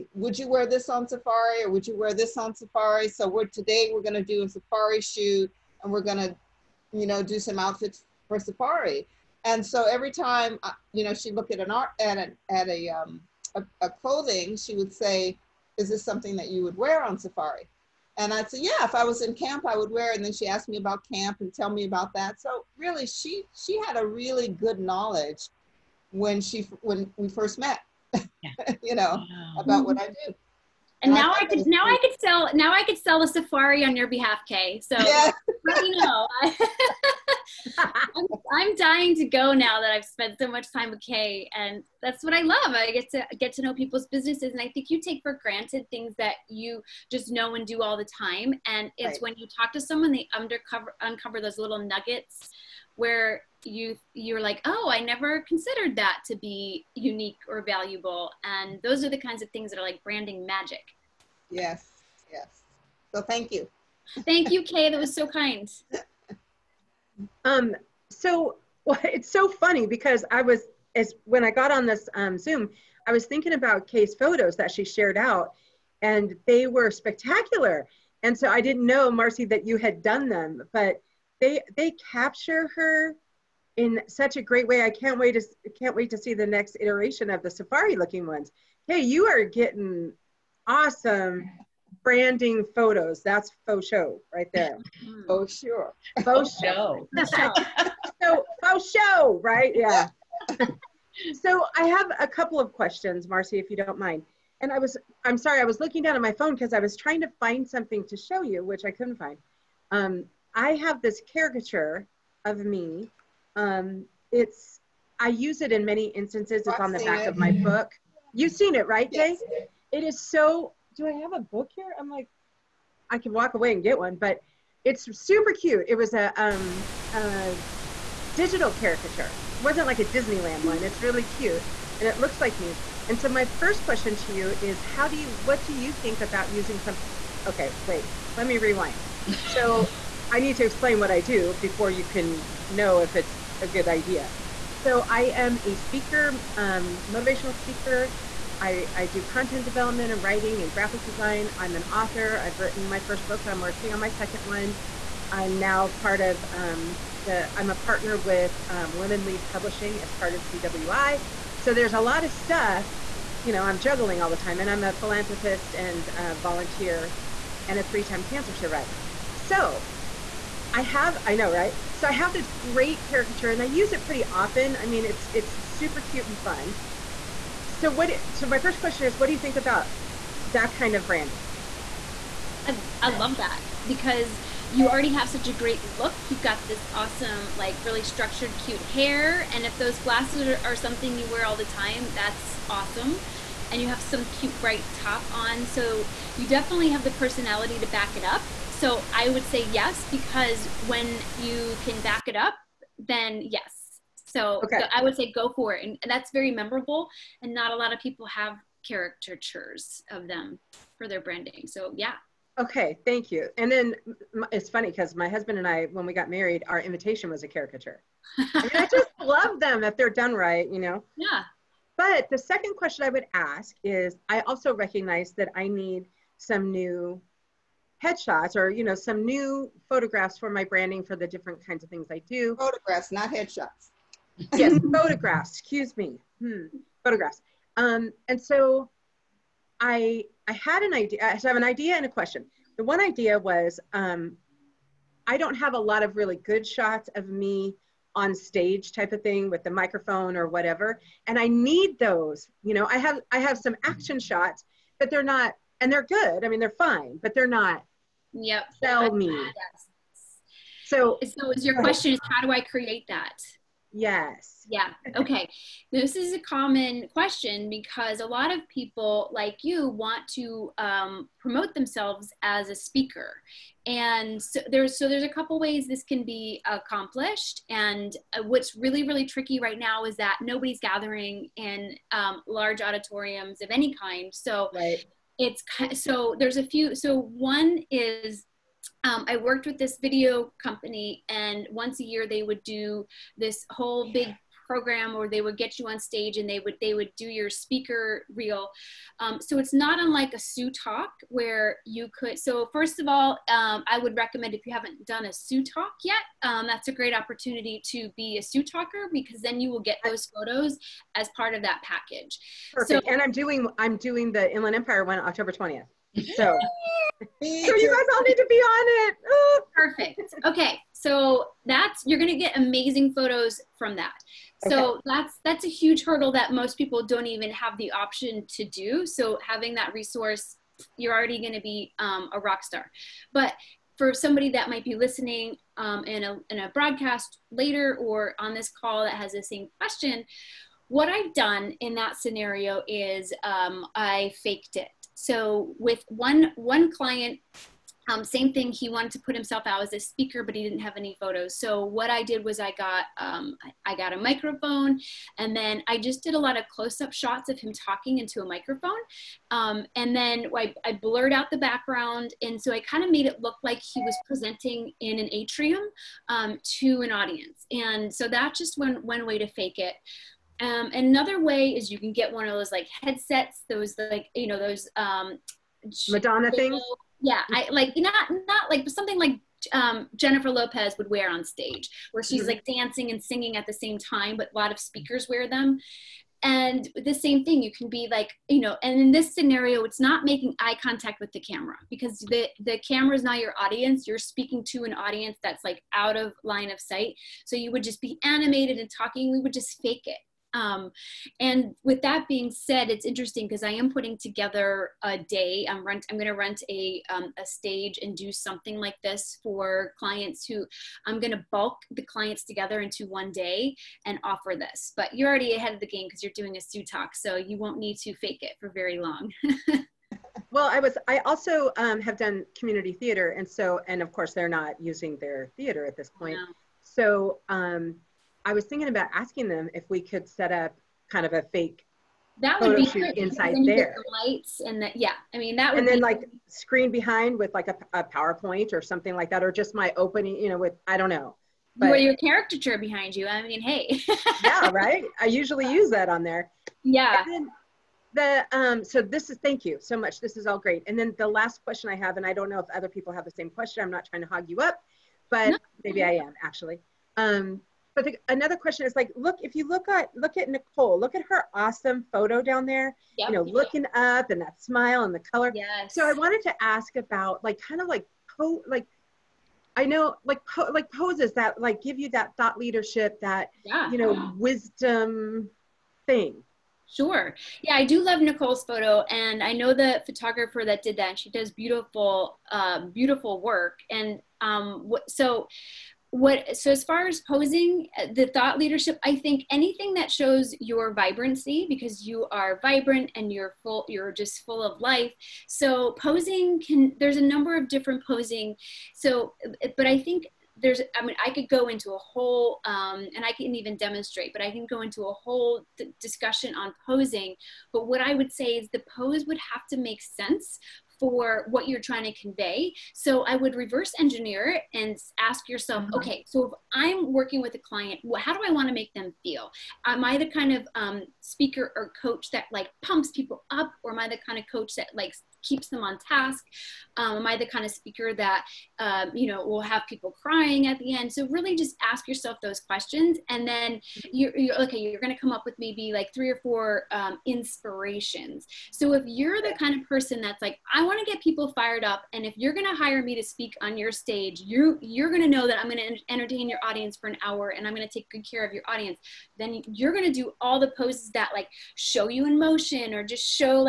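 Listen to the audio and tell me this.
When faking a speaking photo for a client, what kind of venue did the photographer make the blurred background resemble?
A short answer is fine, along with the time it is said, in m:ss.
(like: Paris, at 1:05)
An atrium, at 6:05.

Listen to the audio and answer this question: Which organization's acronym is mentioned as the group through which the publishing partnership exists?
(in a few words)
CWI.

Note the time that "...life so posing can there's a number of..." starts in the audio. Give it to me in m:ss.
8:14.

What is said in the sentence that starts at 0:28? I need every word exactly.
you know, about what I do.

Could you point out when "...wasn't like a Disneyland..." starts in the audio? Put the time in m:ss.
2:09.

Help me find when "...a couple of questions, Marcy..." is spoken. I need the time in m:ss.
1:42.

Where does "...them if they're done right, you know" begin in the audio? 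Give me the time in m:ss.
3:39.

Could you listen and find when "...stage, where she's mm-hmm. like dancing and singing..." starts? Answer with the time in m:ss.
6:21.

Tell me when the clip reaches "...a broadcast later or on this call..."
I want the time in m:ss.
5:36.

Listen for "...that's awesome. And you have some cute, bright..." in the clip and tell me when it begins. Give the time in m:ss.
3:12.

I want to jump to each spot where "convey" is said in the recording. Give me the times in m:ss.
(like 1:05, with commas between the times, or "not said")
8:32.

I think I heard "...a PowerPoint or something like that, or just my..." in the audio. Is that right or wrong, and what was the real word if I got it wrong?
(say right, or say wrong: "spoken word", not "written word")
right.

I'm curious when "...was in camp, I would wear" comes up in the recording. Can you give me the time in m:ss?
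0:19.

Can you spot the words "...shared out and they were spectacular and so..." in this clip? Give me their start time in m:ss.
1:14.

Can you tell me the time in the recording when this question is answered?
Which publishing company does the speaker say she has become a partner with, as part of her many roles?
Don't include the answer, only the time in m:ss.
2:38.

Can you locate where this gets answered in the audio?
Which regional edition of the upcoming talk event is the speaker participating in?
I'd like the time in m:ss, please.
5:14.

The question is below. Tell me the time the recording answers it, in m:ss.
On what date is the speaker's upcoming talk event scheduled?
5:15.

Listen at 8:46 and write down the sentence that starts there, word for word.
Um, am I the kind of speaker that, um, you know, will have people crying at the end?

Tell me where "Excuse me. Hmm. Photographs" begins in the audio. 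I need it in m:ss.
3:55.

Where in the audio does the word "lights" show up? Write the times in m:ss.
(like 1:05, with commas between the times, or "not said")
7:14.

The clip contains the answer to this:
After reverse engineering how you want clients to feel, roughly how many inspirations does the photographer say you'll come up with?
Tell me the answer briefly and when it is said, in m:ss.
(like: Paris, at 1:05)
3 or 4, at 8:56.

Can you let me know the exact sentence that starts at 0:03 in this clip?
So we're, today we're gonna do a safari shoot and we're gonna, you know, do some outfits for safari.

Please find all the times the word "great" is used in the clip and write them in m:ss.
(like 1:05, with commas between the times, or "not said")
1:24, 2:52, 3:05, 5:06, 7:30.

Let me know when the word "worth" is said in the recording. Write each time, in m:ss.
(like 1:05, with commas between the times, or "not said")
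not said.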